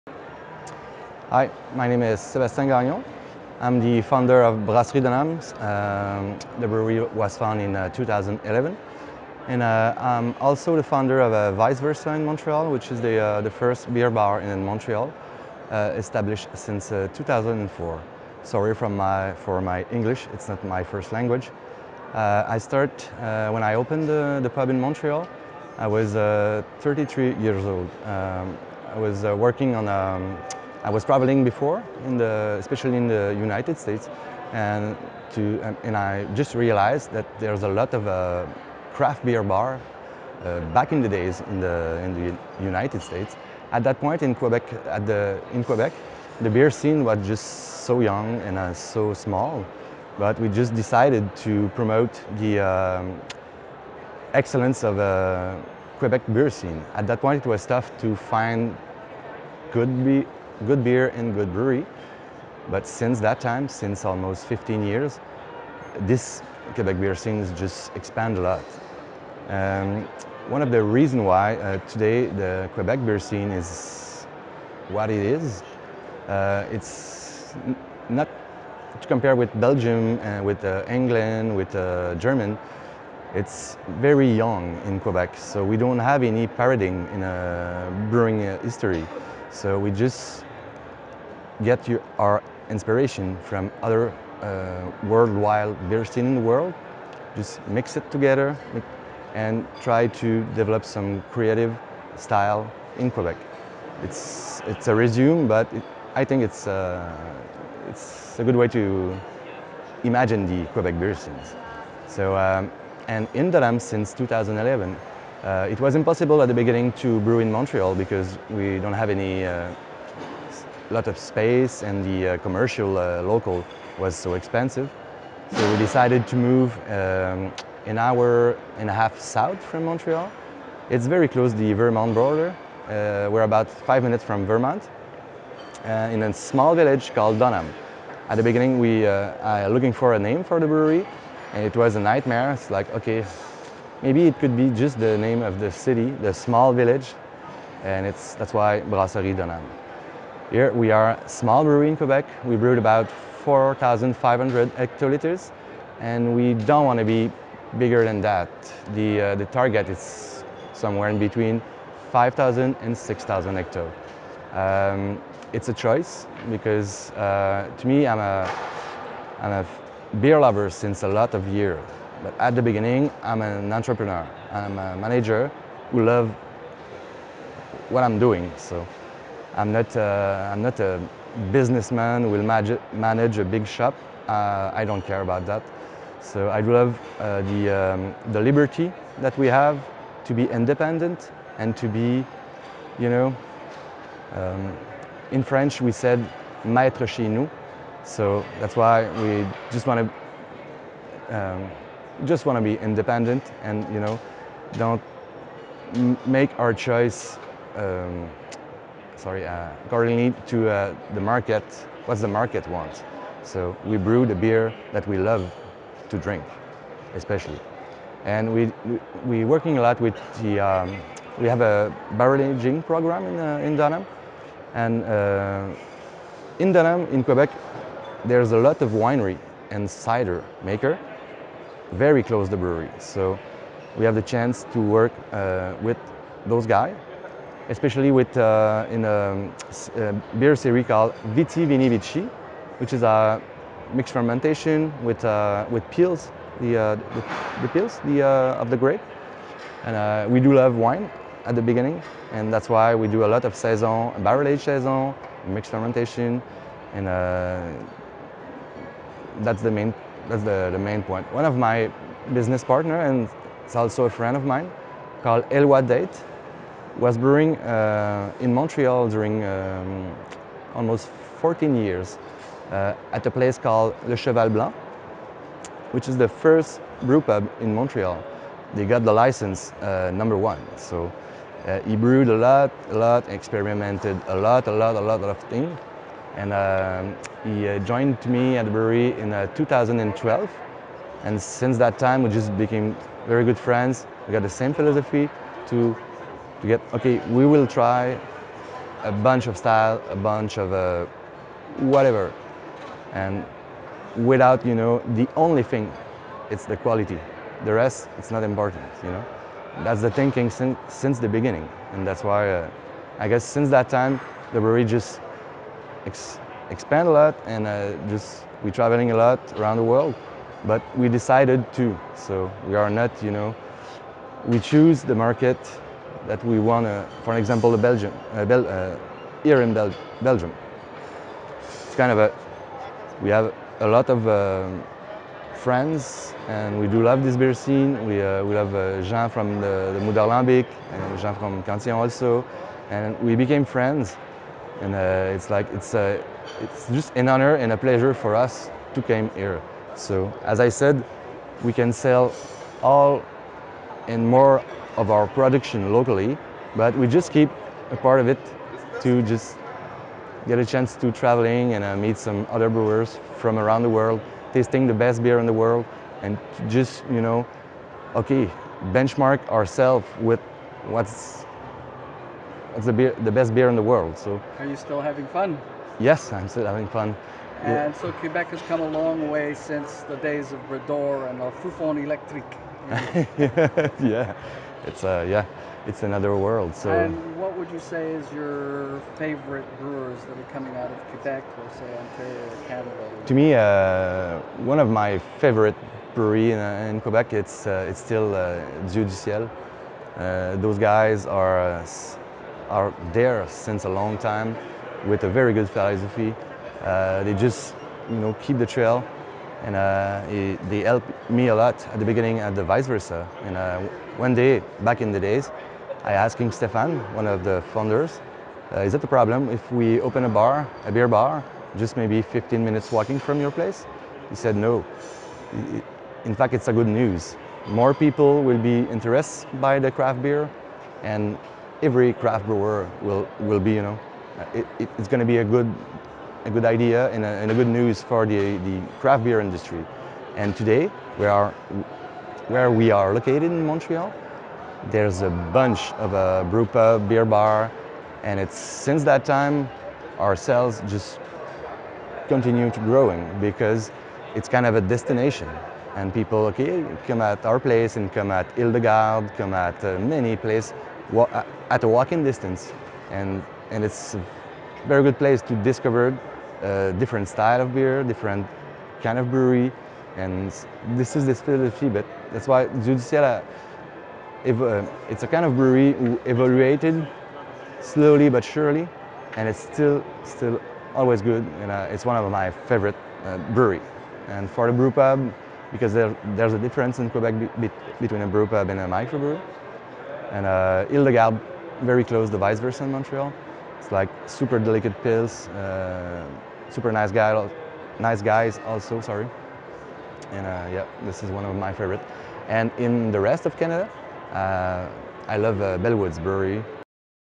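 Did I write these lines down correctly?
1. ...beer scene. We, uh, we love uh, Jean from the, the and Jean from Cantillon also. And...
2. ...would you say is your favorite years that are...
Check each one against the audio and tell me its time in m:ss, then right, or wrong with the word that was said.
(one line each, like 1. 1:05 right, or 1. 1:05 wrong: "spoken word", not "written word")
1. 5:37 right
2. 6:27 wrong: "brewers", not "years".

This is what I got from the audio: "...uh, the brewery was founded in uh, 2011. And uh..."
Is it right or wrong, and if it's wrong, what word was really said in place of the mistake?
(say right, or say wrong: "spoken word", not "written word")
right.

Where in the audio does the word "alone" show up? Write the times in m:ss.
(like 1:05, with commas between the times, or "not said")
not said.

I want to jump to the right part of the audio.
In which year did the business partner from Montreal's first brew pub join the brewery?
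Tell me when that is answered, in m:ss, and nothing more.
4:49.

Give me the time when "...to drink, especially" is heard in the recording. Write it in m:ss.
3:36.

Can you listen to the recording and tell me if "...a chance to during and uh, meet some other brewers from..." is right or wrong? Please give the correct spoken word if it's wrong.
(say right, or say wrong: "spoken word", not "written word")
wrong: "traveling", not "during".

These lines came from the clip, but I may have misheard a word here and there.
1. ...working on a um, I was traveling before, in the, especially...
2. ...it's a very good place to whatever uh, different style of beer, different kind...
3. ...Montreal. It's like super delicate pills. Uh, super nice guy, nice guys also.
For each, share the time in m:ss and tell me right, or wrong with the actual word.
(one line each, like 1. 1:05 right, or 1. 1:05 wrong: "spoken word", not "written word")
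1. 0:29 right
2. 7:43 wrong: "discover", not "whatever"
3. 8:12 right.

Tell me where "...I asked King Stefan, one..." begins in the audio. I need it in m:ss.
6:56.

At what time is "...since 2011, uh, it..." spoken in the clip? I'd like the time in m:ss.
1:53.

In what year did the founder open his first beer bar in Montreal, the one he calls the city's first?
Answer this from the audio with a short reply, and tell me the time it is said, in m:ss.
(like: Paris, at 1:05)
2004, at 0:16.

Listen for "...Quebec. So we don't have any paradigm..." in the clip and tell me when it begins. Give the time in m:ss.
1:24.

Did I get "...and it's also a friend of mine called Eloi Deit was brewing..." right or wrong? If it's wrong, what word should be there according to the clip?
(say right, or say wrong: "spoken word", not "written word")
right.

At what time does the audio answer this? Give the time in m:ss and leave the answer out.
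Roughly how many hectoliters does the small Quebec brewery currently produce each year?
2:33.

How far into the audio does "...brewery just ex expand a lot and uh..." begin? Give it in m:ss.
5:14.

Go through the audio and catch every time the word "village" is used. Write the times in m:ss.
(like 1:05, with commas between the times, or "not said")
2:16, 2:26.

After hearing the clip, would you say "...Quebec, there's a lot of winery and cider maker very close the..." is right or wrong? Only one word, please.
right.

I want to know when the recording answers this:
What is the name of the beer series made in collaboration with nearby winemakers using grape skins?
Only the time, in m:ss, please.
4:01.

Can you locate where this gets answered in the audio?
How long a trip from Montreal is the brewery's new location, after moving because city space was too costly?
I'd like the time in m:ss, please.
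2:07.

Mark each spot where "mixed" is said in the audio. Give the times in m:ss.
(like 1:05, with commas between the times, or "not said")
4:03, 4:15.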